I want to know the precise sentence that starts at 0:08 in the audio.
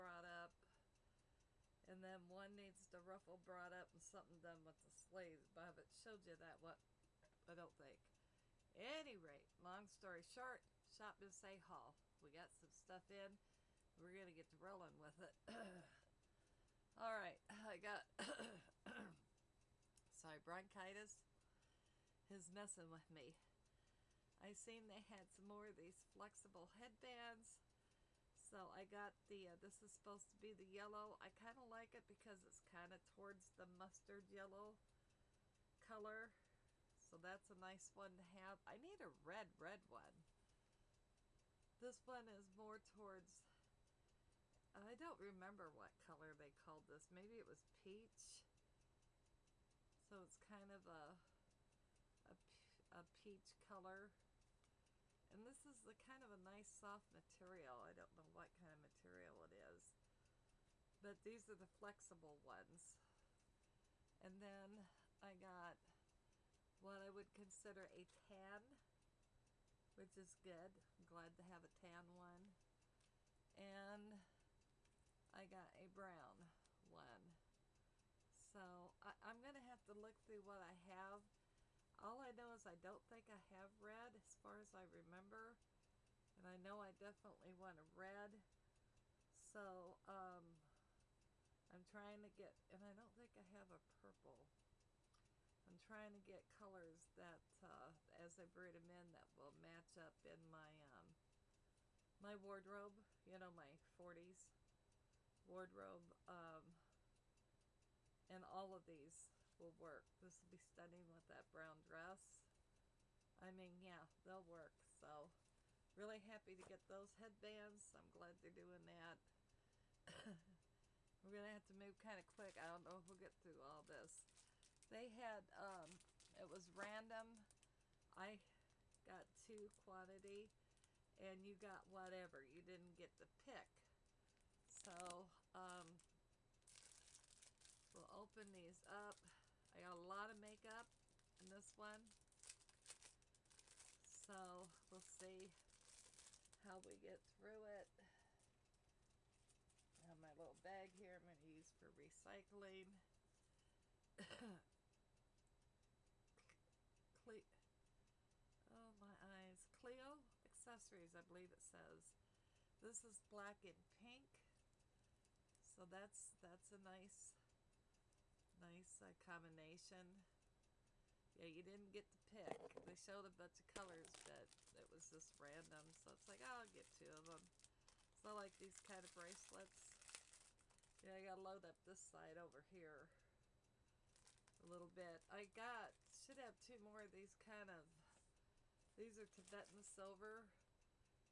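Any rate, long story short, shop Miss A Hall.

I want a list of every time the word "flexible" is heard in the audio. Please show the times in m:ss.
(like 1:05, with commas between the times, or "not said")
0:26, 1:01.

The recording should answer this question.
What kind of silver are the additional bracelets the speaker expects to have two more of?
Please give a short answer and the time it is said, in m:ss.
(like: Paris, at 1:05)
Tibetan silver, at 3:09.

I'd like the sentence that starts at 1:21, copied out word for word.
All I know is I don't think I have red as far as I remember.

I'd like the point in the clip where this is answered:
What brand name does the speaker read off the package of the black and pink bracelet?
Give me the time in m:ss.
2:39.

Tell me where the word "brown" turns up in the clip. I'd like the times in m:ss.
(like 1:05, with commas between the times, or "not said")
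1:15, 1:51.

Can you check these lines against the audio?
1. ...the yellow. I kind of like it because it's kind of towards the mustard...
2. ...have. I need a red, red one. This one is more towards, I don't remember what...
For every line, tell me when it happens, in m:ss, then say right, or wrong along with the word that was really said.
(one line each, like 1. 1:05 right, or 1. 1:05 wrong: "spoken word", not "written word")
1. 0:30 right
2. 0:38 right.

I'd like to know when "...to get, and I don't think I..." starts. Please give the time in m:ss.
1:32.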